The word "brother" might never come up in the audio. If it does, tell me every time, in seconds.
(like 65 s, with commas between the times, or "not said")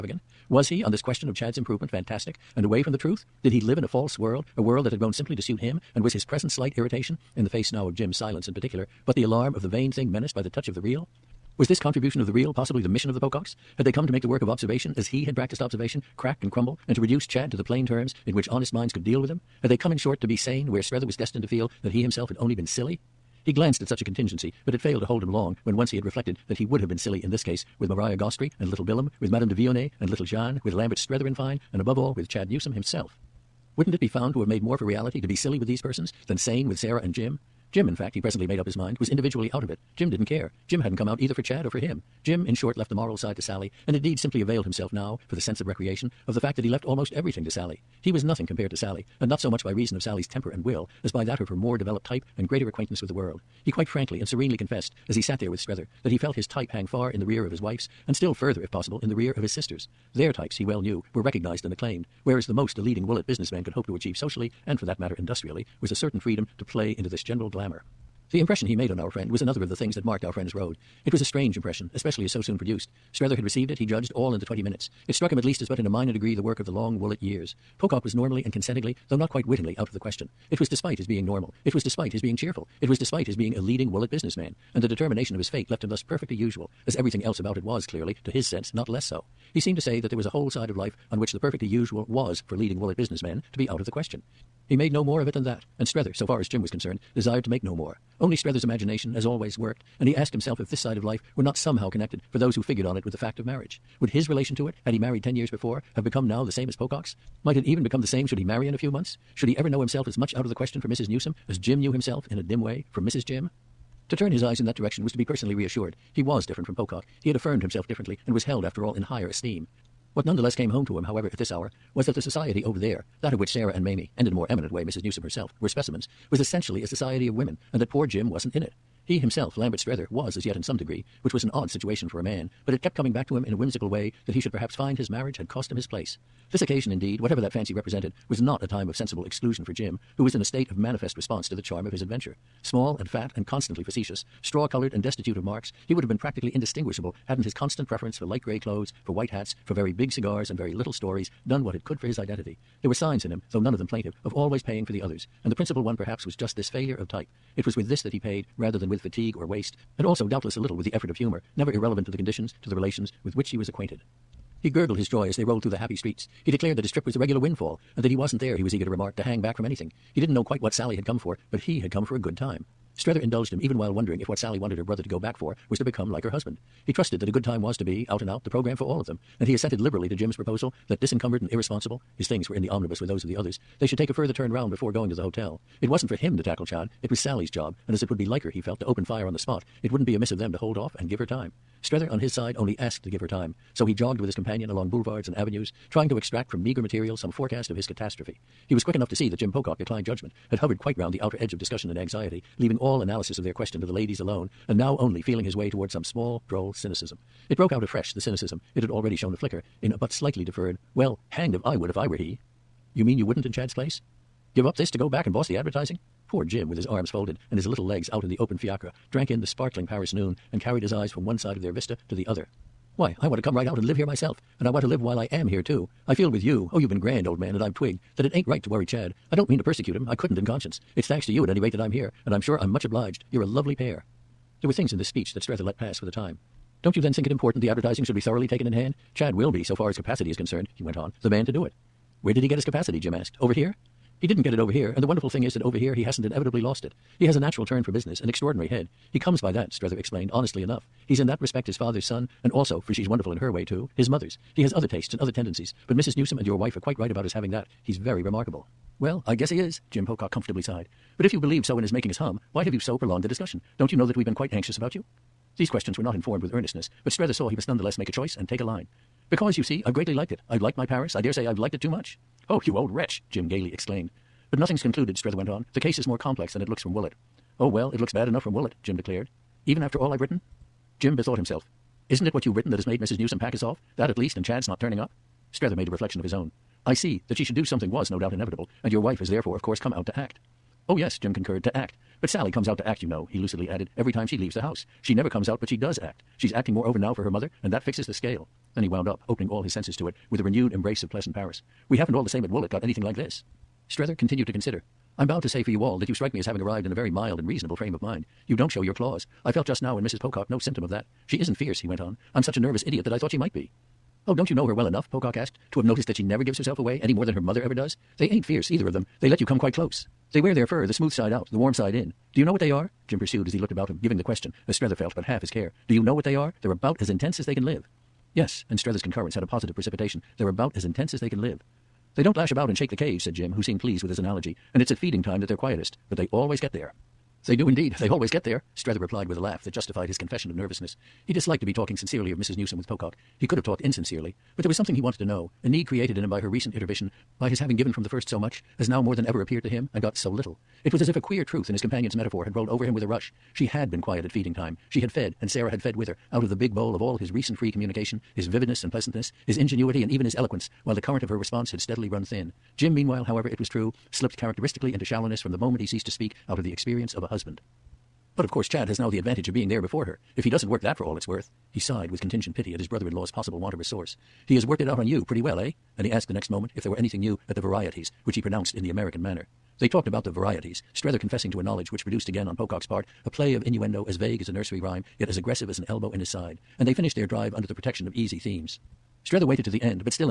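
174 s, 372 s.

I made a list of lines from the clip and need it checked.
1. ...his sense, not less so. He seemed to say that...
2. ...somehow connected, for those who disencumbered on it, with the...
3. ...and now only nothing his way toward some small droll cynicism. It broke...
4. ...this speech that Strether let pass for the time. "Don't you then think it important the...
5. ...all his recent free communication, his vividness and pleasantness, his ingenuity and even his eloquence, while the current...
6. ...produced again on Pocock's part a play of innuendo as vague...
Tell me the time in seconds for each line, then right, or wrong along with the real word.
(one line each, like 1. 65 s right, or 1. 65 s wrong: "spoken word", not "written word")
1. 88 s right
2. 101 s wrong: "figured", not "disencumbered"
3. 204 s wrong: "feeling", not "nothing"
4. 234 s right
5. 357 s right
6. 382 s right.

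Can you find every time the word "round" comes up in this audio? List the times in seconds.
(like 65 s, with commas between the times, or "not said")
184 s, 200 s.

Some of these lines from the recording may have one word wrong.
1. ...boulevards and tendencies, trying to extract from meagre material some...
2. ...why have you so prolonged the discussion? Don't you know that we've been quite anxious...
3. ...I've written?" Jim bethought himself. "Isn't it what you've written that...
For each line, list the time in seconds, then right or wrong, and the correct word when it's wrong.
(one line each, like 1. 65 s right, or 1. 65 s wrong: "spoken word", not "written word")
1. 194 s wrong: "avenues", not "tendencies"
2. 262 s right
3. 280 s right.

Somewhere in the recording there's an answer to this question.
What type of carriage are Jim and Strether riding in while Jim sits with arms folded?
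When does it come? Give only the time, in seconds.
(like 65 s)
218 s.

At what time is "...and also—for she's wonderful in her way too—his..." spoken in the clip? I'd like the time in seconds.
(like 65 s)
252 s.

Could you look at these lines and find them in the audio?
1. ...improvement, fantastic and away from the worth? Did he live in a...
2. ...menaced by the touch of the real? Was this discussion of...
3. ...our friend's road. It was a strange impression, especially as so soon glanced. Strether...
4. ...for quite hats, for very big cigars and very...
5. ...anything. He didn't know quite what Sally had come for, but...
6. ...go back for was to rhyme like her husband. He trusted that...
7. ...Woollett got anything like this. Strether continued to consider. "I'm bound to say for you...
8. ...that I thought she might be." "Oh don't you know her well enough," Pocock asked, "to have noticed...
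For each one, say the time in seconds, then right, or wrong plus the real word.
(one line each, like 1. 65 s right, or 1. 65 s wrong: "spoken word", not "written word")
1. 1 s wrong: "truth", not "worth"
2. 10 s wrong: "contribution", not "discussion"
3. 70 s wrong: "produced", not "glanced"
4. 149 s wrong: "white", not "quite"
5. 169 s right
6. 175 s wrong: "become", not "rhyme"
7. 302 s right
8. 313 s right.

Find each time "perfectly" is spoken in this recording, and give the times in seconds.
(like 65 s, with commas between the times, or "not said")
86 s, 91 s.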